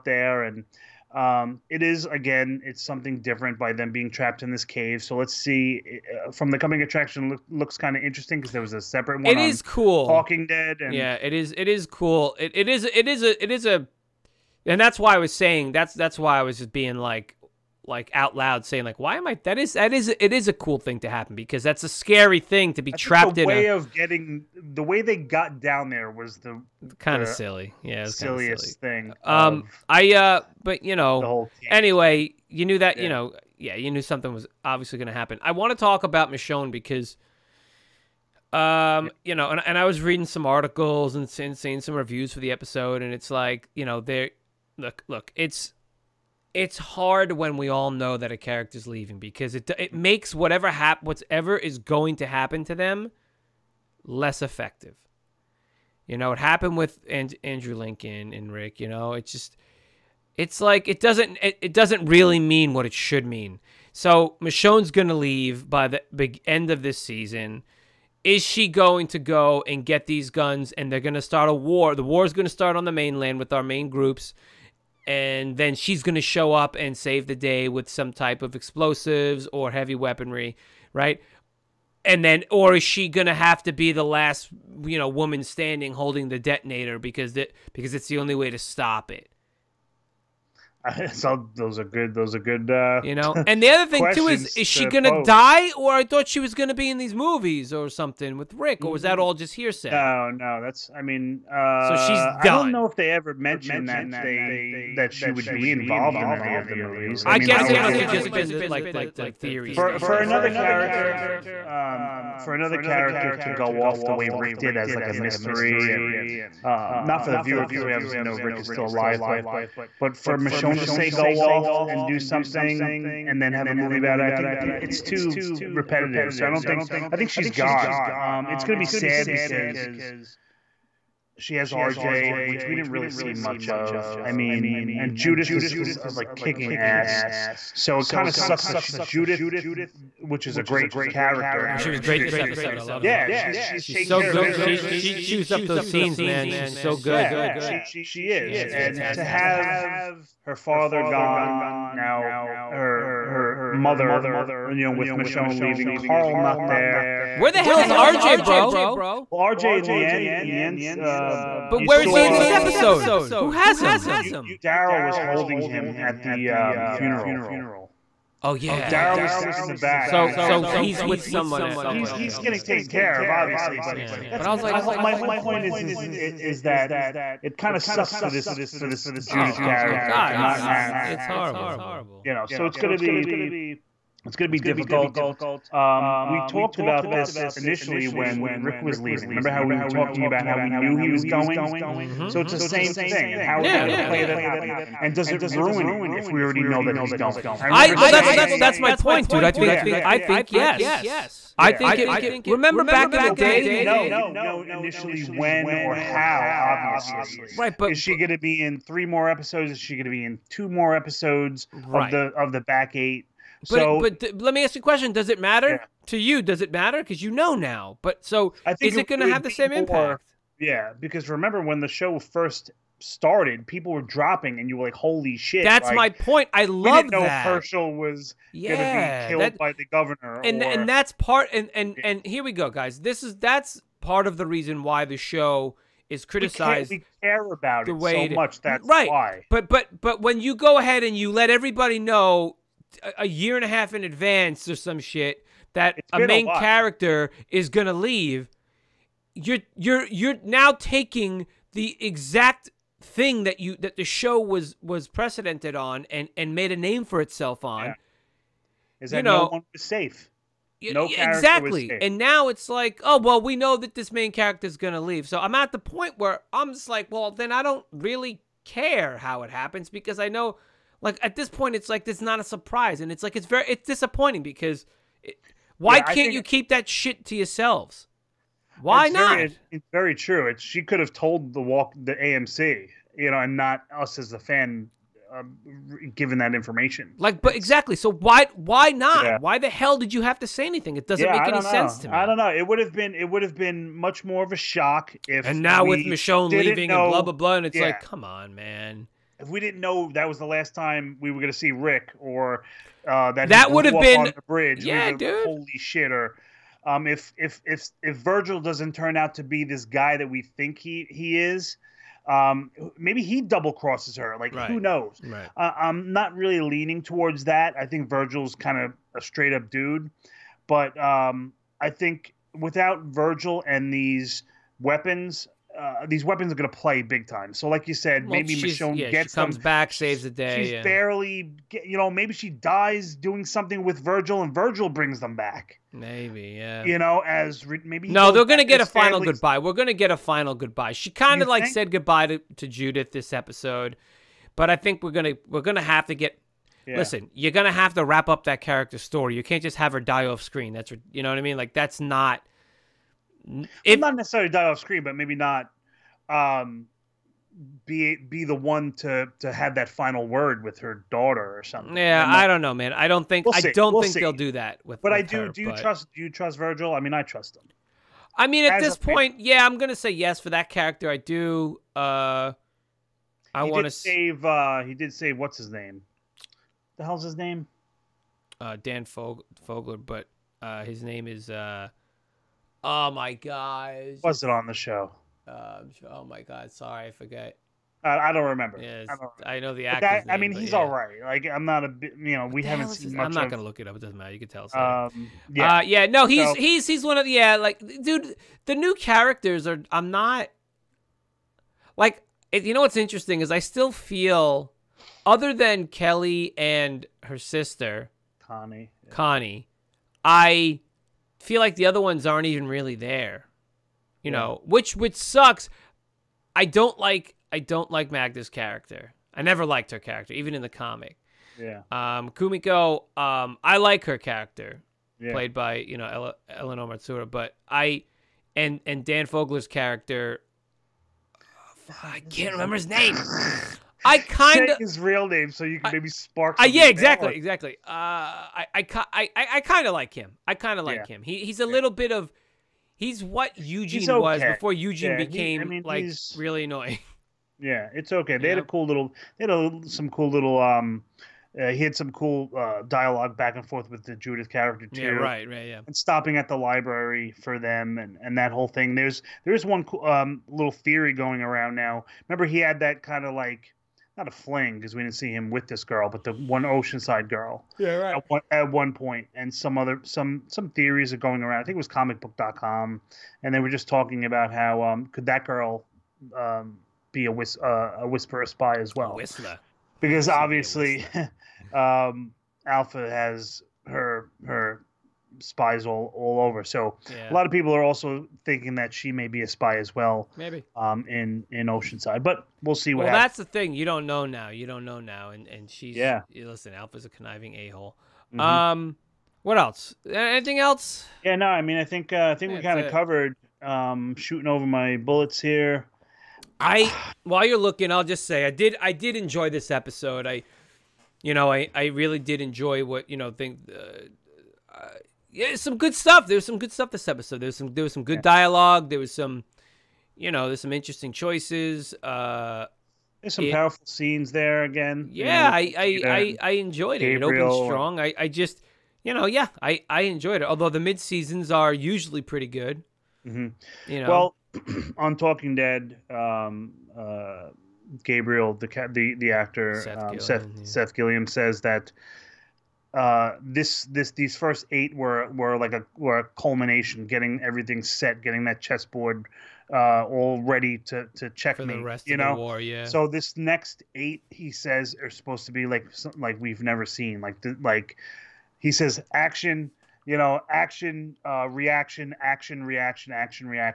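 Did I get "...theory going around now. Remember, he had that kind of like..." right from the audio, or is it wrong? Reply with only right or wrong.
right.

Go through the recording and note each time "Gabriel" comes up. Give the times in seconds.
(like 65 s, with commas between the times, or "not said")
527 s, 538 s.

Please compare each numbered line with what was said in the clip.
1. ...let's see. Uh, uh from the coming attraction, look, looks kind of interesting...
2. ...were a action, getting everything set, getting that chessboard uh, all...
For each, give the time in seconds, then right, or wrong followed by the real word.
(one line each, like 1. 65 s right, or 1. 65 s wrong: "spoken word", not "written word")
1. 5 s right
2. 545 s wrong: "culmination", not "action".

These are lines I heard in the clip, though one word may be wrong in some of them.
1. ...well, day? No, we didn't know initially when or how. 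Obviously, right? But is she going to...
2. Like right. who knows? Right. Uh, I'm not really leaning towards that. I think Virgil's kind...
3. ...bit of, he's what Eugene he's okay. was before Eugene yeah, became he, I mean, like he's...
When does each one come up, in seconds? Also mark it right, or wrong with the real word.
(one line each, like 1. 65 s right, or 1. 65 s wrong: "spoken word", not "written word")
1. 203 s right
2. 314 s right
3. 441 s right.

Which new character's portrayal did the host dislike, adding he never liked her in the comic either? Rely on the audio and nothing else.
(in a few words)
Magna.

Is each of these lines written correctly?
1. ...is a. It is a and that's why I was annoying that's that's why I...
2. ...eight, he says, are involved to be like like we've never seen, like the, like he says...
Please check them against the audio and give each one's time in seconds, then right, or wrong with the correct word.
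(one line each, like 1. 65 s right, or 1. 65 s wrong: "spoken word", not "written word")
1. 13 s wrong: "saying", not "annoying"
2. 553 s wrong: "supposed", not "involved".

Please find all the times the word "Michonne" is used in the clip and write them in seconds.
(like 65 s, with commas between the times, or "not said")
36 s, 64 s, 120 s, 155 s, 295 s, 328 s.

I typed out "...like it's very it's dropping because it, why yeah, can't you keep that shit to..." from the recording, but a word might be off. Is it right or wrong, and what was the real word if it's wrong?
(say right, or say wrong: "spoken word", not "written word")
wrong: "disappointing", not "dropping".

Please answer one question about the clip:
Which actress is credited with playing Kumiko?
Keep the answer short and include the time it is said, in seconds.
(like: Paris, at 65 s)
Eleanor Matsuura, at 426 s.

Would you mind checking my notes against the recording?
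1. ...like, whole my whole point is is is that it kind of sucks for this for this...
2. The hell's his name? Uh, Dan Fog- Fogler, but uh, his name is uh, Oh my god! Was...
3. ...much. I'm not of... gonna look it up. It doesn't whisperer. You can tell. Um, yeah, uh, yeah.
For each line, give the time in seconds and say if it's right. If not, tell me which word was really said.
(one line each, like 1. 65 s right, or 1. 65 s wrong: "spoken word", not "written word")
1. 174 s right
2. 376 s right
3. 393 s wrong: "matter", not "whisperer".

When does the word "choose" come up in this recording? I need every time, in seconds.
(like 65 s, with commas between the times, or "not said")
not said.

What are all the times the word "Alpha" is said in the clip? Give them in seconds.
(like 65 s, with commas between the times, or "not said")
482 s, 496 s.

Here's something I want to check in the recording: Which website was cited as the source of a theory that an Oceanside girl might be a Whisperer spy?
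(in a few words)
ComicBook.com.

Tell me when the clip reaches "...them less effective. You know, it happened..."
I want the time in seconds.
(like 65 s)
52 s.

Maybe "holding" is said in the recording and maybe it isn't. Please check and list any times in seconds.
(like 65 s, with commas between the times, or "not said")
85 s, 165 s.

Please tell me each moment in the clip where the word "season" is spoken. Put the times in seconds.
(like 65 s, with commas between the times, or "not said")
66 s, 530 s.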